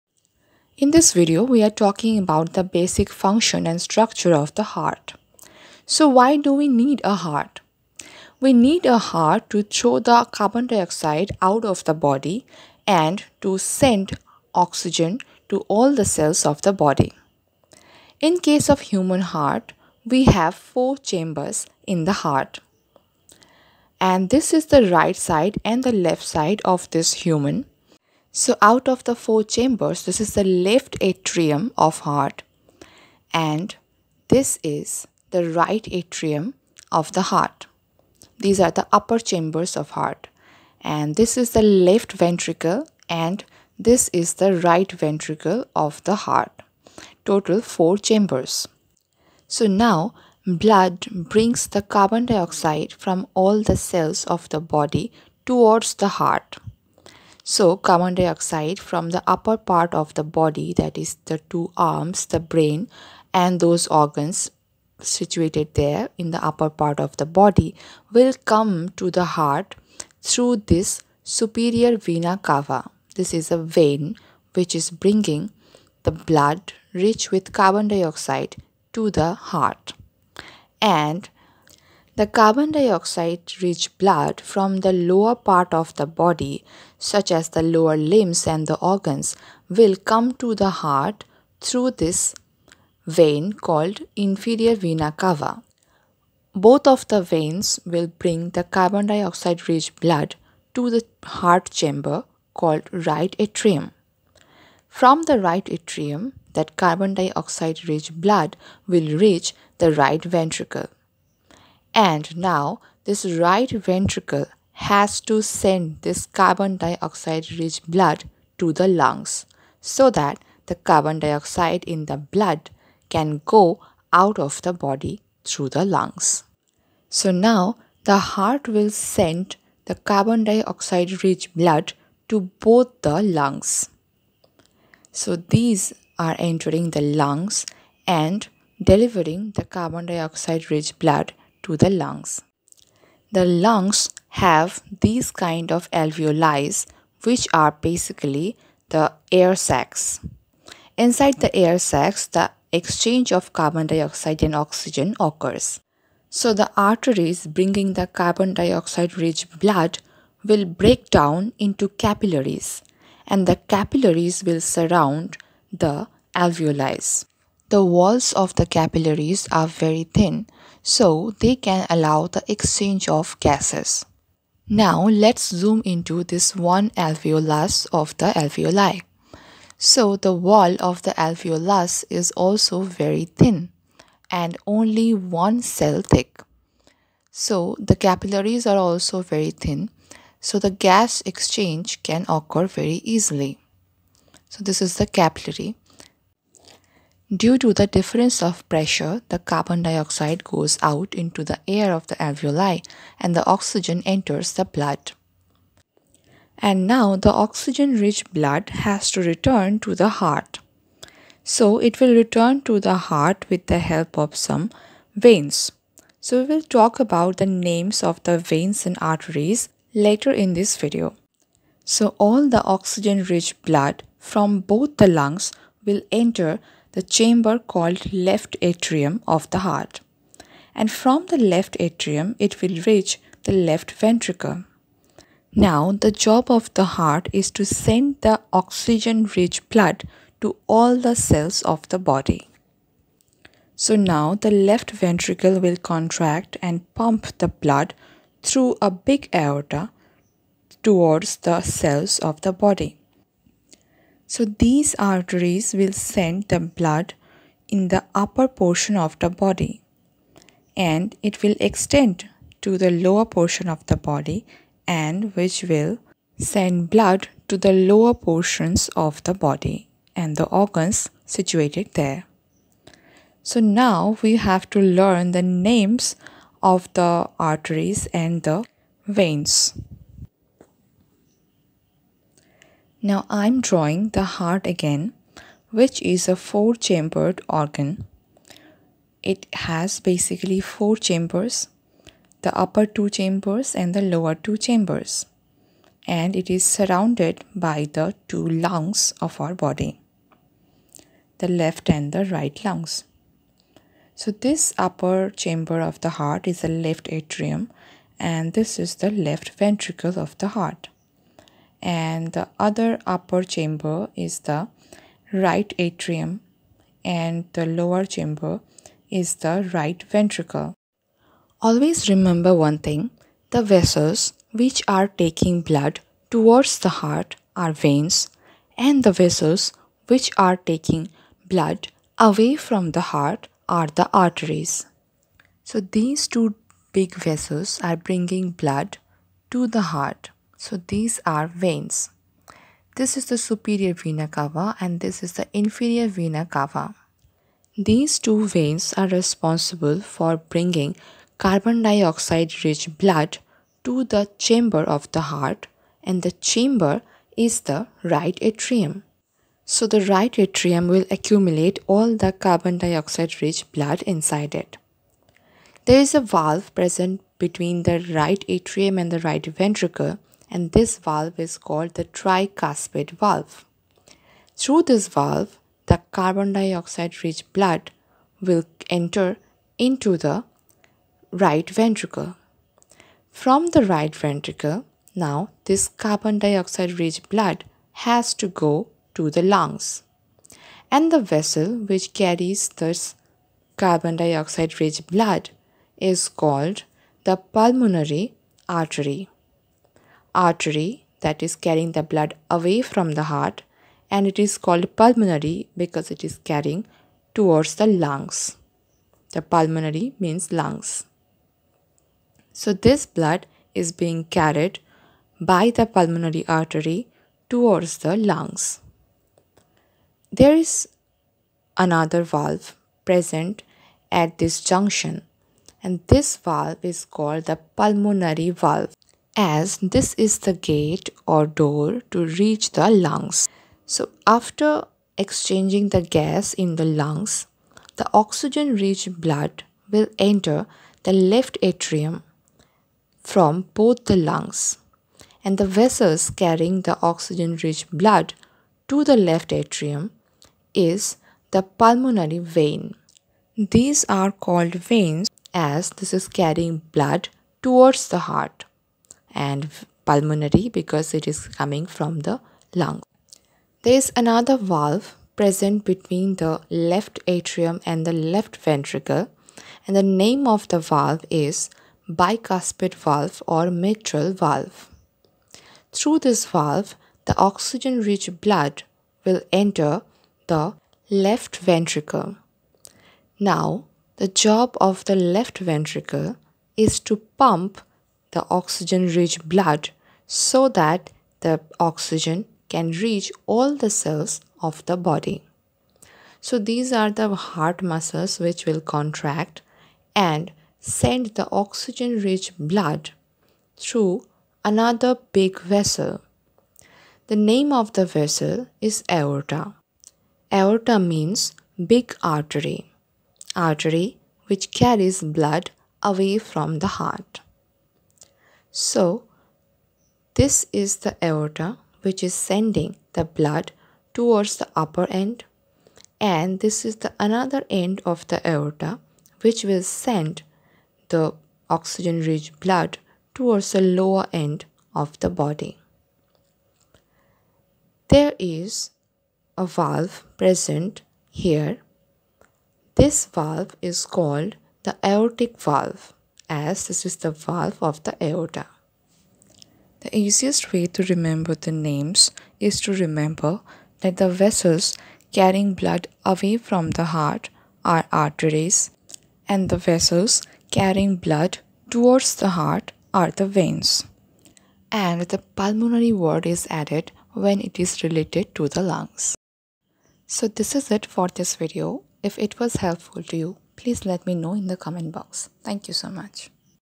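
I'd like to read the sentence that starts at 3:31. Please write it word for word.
So it will return to the heart with the help of some veins.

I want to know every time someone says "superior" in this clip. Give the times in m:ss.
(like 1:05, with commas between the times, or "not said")
1:11, 5:43.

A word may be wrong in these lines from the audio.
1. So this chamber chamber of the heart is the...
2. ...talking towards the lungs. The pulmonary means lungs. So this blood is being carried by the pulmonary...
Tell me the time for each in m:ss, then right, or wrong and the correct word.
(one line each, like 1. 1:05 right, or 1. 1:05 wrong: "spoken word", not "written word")
1. 5:04 wrong: "upper", not "chamber"
2. 6:46 wrong: "carrying", not "talking".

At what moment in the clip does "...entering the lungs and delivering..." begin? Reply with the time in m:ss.
2:16.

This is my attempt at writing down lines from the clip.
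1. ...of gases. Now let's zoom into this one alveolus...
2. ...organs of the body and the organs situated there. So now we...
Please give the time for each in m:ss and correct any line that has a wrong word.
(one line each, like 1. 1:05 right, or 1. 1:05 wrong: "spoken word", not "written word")
1. 2:53 right
2. 4:28 wrong: "portions", not "organs".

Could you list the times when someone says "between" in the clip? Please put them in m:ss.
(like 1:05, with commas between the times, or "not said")
6:07, 7:45.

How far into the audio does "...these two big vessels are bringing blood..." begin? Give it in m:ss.
5:35.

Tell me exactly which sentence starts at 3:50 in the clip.
And from the left atrium, it will reach the left ventricle.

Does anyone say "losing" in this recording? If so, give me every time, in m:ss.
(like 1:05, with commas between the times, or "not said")
not said.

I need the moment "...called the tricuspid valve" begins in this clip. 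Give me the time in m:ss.
6:11.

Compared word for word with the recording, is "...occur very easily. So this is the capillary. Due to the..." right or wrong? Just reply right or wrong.
right.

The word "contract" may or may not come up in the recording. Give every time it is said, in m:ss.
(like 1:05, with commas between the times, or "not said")
4:05, 8:18.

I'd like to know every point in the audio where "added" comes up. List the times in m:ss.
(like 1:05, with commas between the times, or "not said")
9:26.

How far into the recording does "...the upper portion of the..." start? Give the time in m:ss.
4:17.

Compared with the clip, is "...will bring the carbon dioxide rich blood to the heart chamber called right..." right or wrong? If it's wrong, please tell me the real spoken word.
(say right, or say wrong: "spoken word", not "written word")
right.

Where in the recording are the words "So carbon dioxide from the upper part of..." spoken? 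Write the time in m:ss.
0:57.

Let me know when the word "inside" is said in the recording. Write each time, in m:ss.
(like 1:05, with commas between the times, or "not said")
2:30, 6:04.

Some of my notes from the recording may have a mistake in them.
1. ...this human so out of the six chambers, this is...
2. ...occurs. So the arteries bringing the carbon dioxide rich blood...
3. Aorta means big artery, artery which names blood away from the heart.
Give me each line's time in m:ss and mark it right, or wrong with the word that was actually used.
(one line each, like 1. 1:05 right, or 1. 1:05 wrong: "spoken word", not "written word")
1. 0:26 wrong: "four", not "six"
2. 2:35 right
3. 8:30 wrong: "carries", not "names".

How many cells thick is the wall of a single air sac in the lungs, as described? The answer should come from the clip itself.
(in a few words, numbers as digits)
1.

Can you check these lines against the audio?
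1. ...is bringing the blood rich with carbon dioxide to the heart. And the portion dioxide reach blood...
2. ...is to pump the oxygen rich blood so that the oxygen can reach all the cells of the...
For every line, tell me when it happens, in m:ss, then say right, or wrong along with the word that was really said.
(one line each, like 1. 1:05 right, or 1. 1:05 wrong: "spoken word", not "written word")
1. 1:14 wrong: "carbon", not "portion"
2. 8:06 right.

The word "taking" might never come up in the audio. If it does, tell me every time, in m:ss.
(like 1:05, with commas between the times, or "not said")
5:25, 5:30.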